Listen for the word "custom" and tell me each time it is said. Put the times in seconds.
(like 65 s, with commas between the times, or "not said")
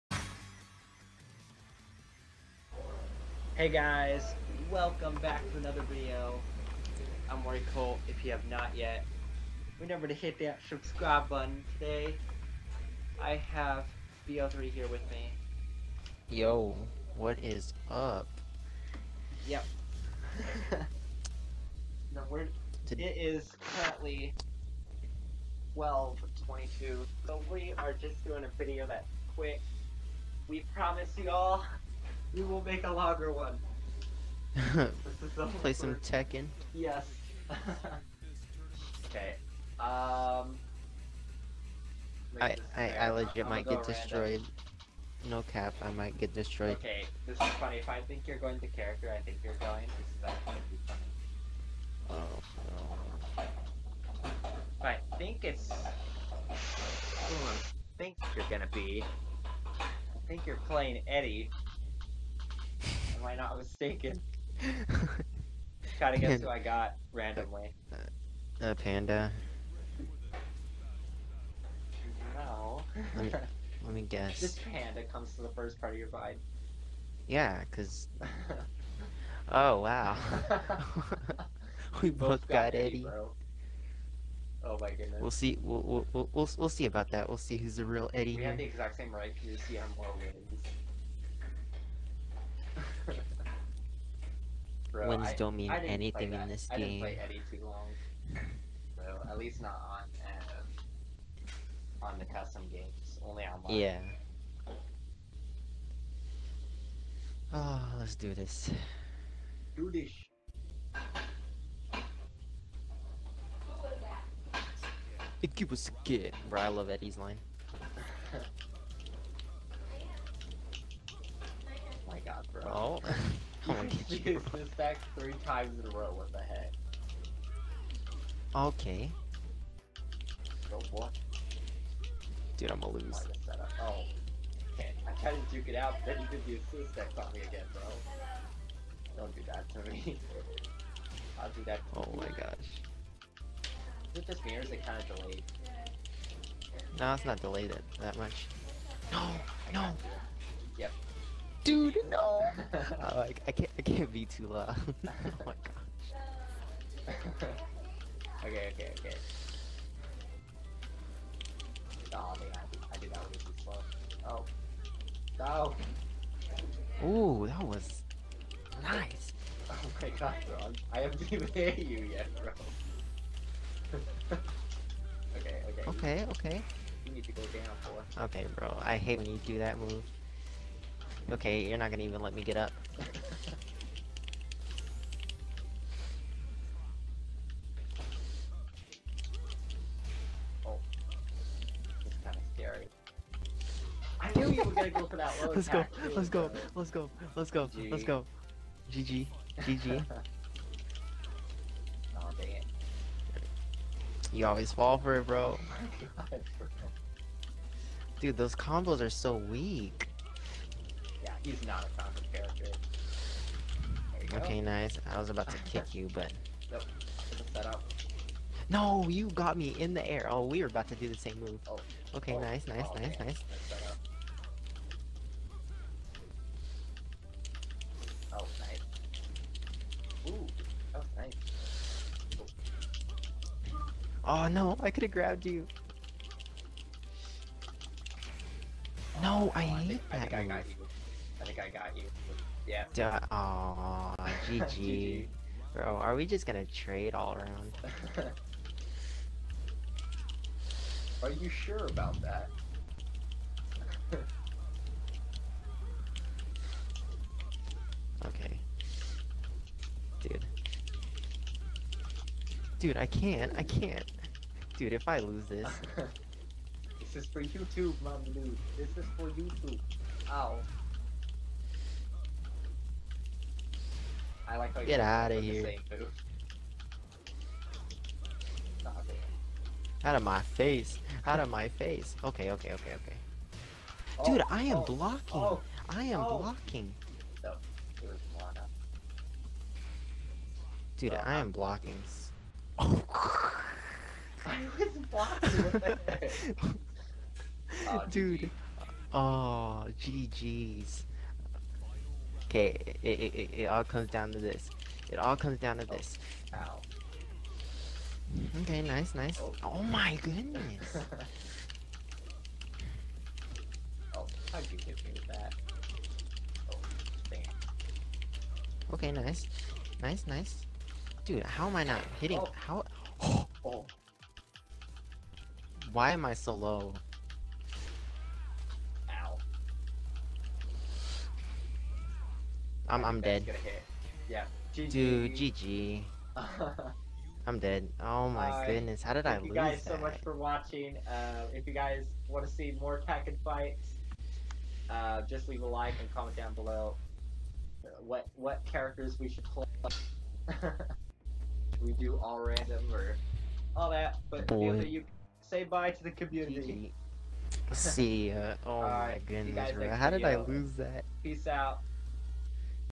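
102 s.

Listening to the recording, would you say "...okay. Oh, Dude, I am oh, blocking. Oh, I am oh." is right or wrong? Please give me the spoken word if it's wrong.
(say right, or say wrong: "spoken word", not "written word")
right.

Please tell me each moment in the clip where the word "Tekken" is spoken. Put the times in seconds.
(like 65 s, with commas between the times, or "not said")
35 s, 343 s.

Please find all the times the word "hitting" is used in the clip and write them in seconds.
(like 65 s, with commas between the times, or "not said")
322 s.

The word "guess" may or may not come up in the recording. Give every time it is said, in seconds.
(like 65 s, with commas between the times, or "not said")
66 s, 74 s.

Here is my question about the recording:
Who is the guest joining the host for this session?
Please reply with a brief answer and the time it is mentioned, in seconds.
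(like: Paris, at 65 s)
BL3, at 14 s.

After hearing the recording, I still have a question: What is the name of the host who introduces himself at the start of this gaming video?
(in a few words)
Roy Colt.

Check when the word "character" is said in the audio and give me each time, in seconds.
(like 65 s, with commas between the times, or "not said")
48 s, 212 s, 348 s.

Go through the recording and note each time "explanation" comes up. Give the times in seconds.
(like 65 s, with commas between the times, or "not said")
not said.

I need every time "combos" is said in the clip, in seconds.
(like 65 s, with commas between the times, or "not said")
208 s.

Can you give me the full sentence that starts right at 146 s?
No, it's not delayed that much.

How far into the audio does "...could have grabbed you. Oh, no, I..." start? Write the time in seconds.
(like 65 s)
234 s.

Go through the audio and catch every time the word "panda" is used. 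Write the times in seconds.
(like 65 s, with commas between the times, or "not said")
68 s, 74 s.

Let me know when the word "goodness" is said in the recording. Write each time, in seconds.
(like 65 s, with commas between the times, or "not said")
84 s, 310 s, 338 s, 359 s.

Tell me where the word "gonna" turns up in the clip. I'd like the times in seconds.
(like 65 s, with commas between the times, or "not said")
58 s, 132 s, 181 s, 246 s.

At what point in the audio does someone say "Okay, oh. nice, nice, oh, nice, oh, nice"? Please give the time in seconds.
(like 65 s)
222 s.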